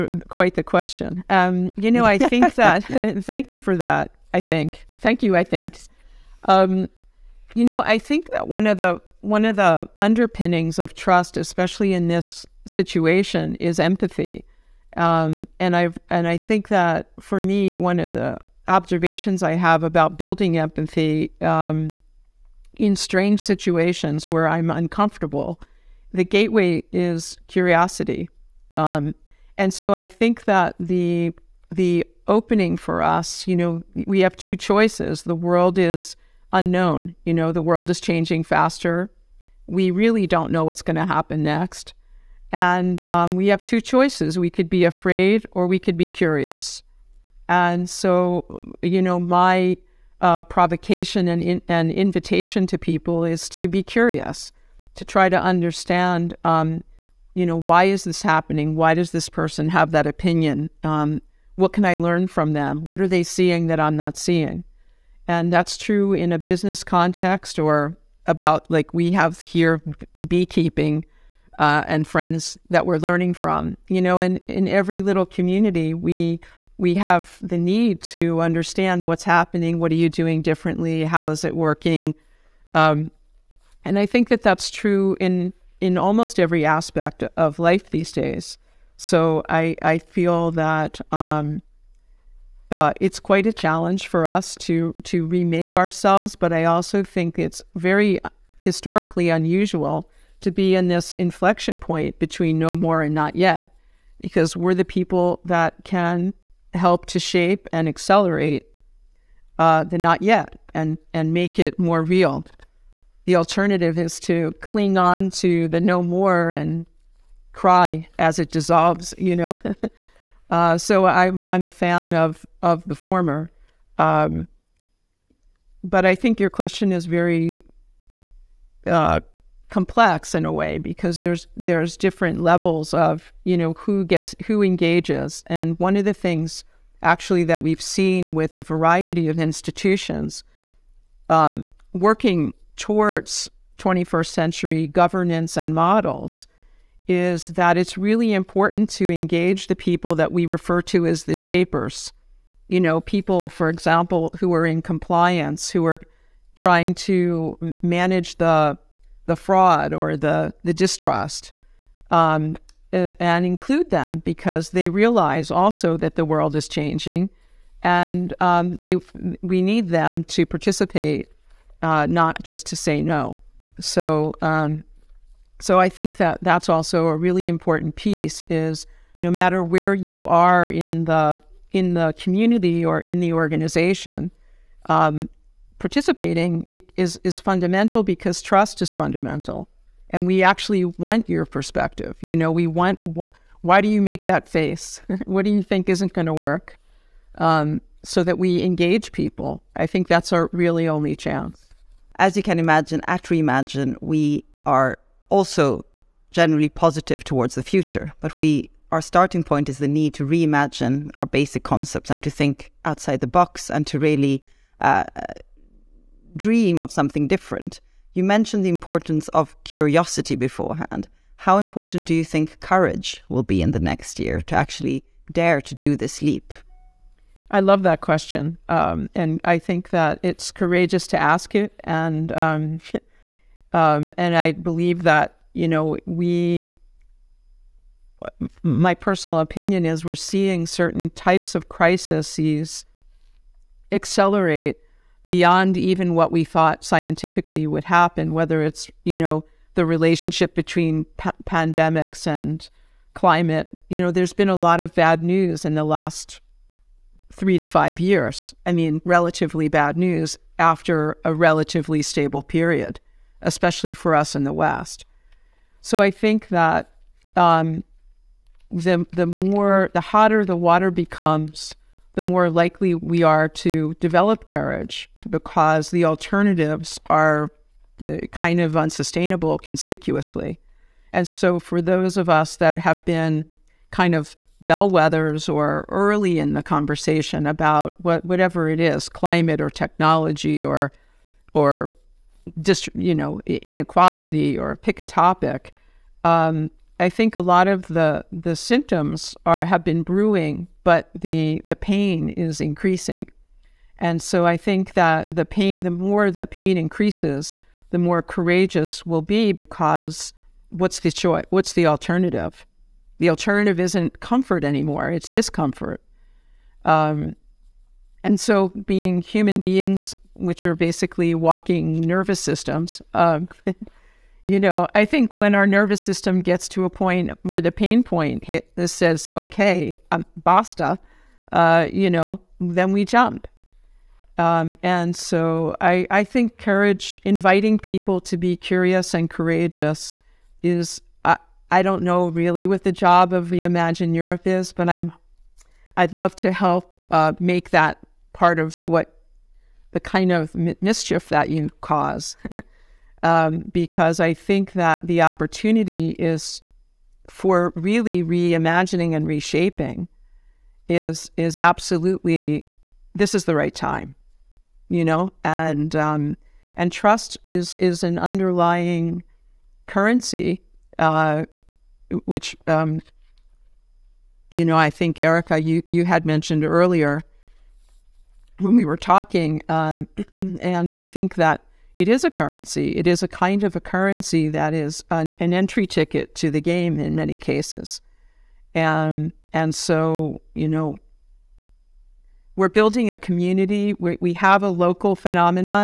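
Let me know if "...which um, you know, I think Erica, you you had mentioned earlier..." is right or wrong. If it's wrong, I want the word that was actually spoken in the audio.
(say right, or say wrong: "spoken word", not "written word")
right.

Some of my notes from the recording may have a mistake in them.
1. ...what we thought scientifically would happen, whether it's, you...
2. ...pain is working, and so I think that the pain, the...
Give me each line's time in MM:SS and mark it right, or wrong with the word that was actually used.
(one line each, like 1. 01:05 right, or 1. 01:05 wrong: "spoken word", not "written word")
1. 04:06 right
2. 05:01 wrong: "increasing", not "working".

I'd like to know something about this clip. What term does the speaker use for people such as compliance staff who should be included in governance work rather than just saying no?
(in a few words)
the shapers.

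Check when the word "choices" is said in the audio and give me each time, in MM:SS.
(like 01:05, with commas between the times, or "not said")
00:34, 00:43, 05:11.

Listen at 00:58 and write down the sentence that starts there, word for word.
Why does this person have that opinion?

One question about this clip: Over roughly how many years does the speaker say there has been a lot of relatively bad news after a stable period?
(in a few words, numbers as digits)
3 to 5.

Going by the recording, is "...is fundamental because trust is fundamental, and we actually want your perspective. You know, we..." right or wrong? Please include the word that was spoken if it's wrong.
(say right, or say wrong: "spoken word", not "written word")
right.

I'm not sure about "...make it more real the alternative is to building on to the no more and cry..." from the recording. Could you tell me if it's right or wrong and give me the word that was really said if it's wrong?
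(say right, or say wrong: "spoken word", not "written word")
wrong: "cling", not "building".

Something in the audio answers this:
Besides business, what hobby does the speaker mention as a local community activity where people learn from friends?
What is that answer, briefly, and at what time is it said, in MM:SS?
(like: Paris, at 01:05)
beekeeping, at 01:10.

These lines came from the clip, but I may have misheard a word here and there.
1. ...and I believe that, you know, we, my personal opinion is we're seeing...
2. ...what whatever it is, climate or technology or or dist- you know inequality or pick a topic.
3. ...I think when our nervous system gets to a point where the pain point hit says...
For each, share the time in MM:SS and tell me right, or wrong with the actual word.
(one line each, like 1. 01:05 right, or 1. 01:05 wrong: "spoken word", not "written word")
1. 03:54 right
2. 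04:47 right
3. 05:24 right.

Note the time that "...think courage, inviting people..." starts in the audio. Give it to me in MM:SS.
05:36.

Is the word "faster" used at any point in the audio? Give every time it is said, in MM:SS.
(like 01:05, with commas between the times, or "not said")
00:38.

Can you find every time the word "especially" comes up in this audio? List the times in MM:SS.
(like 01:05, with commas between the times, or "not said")
00:11, 04:23.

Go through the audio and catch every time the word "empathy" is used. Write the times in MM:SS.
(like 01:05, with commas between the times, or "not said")
00:13, 00:20.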